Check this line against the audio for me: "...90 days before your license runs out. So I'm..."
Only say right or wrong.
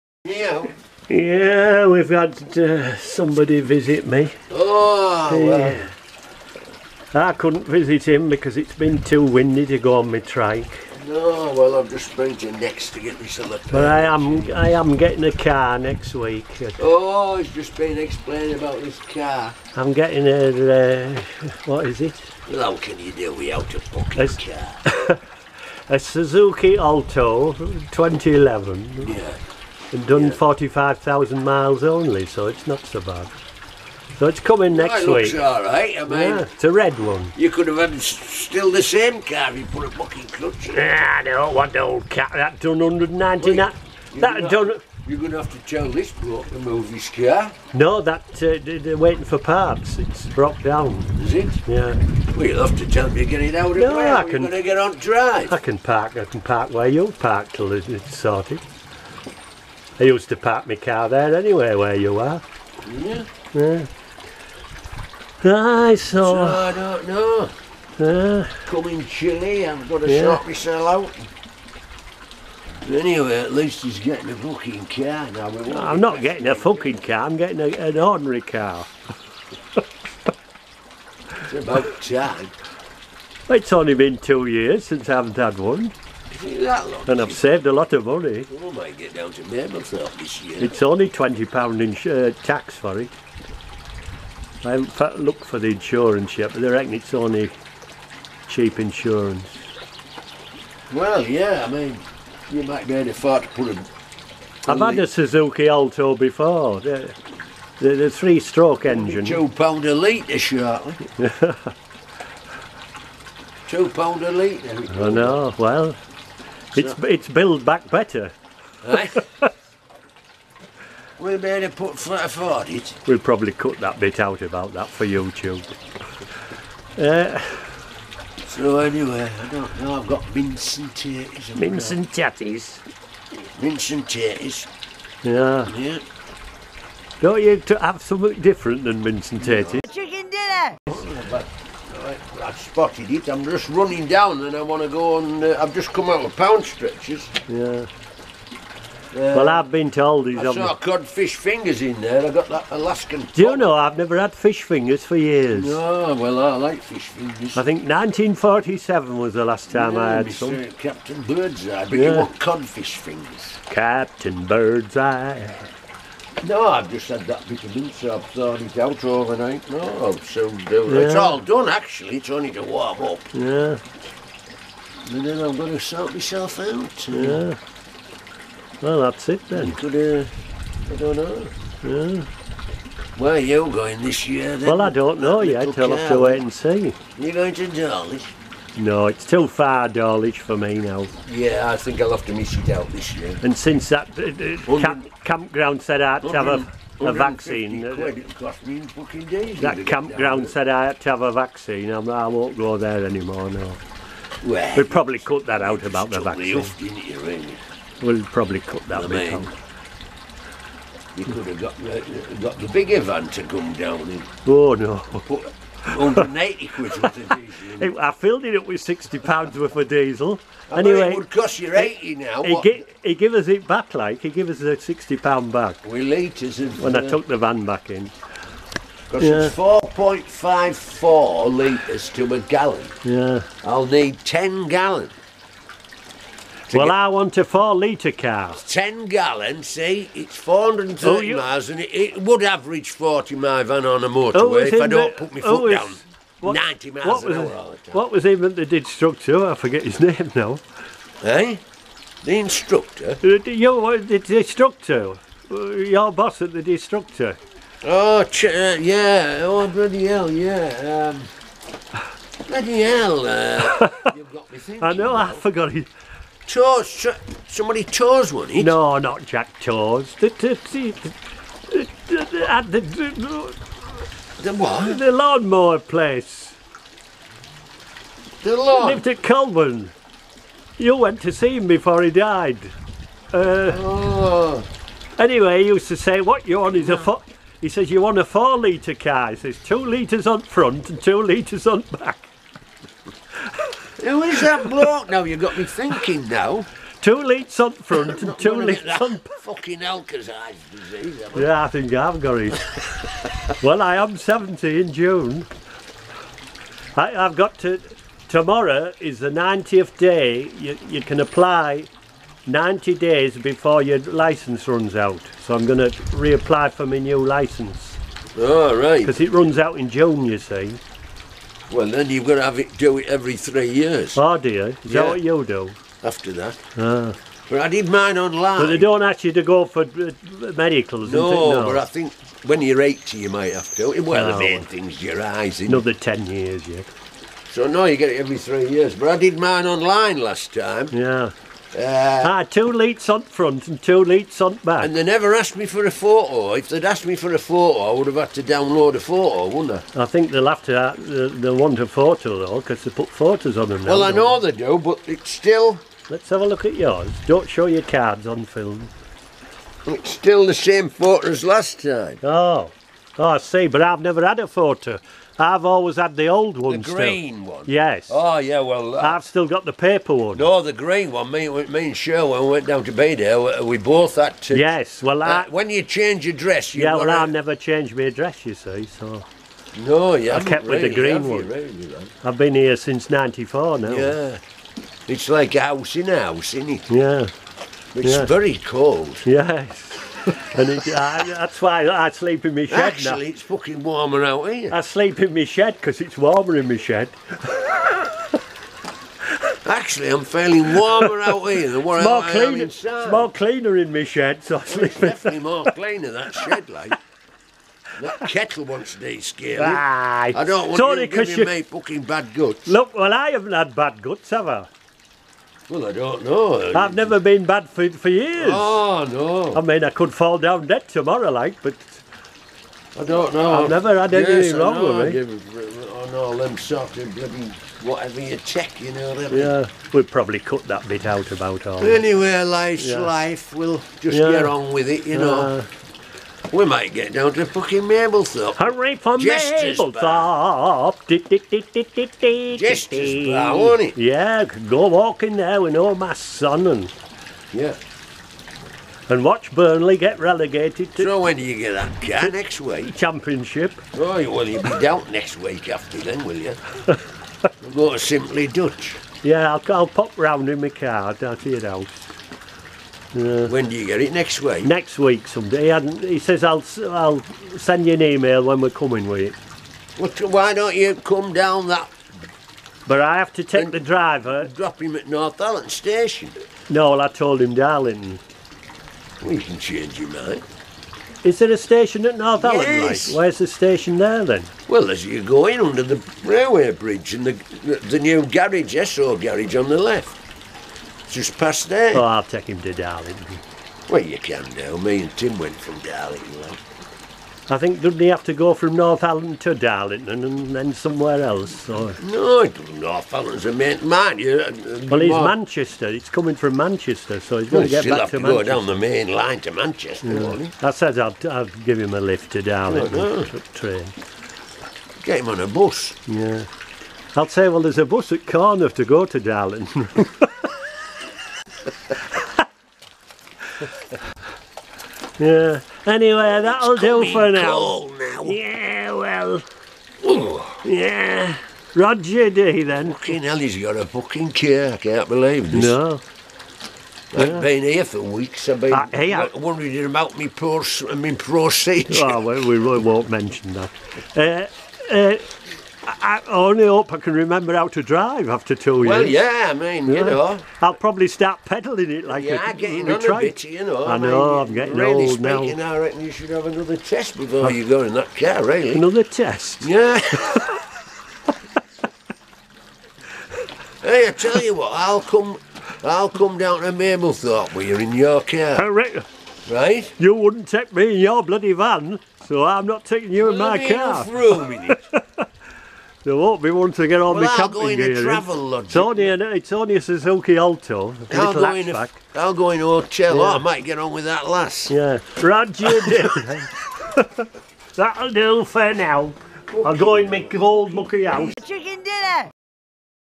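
right.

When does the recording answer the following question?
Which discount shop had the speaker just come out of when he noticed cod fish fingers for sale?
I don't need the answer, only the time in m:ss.
2:26.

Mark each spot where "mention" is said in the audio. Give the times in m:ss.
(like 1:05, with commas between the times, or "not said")
9:03.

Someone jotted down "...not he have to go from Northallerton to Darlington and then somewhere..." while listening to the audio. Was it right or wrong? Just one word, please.
right.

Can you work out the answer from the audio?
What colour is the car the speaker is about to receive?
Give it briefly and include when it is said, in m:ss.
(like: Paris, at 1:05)
Red, at 0:36.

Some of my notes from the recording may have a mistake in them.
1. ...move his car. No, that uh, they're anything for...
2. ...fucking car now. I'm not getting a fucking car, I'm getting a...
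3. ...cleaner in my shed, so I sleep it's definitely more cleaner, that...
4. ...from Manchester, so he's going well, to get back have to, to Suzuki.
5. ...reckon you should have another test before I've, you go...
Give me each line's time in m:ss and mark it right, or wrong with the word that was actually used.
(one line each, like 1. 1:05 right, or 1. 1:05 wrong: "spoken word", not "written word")
1. 0:46 wrong: "waiting", not "anything"
2. 1:14 right
3. 6:43 right
4. 8:26 wrong: "Manchester", not "Suzuki"
5. 9:15 right.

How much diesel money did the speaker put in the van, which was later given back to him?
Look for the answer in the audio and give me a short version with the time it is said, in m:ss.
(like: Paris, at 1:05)
60 pounds, at 3:38.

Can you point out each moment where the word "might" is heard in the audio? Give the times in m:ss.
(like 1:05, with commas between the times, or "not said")
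1:28, 1:42, 5:33, 7:16, 9:43.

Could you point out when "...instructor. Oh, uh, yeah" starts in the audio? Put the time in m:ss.
4:16.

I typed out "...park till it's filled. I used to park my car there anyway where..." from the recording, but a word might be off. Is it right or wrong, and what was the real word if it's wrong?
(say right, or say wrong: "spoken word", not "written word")
wrong: "sorted", not "filled".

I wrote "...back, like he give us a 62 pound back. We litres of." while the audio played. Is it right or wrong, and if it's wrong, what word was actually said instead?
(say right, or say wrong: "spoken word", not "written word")
wrong: "60", not "62".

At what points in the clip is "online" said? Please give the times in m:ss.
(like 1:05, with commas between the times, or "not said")
5:28, 5:39.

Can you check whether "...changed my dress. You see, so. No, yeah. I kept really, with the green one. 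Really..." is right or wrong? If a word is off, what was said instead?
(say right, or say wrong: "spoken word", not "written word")
right.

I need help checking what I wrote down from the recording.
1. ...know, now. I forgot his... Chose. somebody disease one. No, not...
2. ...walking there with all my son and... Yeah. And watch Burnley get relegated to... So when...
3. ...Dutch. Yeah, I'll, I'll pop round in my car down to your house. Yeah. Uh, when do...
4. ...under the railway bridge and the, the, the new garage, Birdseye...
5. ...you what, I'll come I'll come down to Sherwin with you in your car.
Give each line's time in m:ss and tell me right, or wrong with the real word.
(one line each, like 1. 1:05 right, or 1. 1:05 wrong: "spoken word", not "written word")
1. 4:24 wrong: "chose", not "disease"
2. 7:24 right
3. 7:38 right
4. 8:05 wrong: "Esso", not "Birdseye"
5. 9:24 wrong: "Mablethorpe", not "Sherwin".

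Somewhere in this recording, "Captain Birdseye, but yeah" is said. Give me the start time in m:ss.
2:40.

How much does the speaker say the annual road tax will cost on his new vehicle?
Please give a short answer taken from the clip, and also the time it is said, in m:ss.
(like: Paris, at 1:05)
£20, at 1:31.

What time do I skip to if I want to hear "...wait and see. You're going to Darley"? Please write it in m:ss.
3:06.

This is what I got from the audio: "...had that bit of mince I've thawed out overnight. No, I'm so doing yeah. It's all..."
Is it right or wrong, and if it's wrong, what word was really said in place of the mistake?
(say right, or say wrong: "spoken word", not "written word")
right.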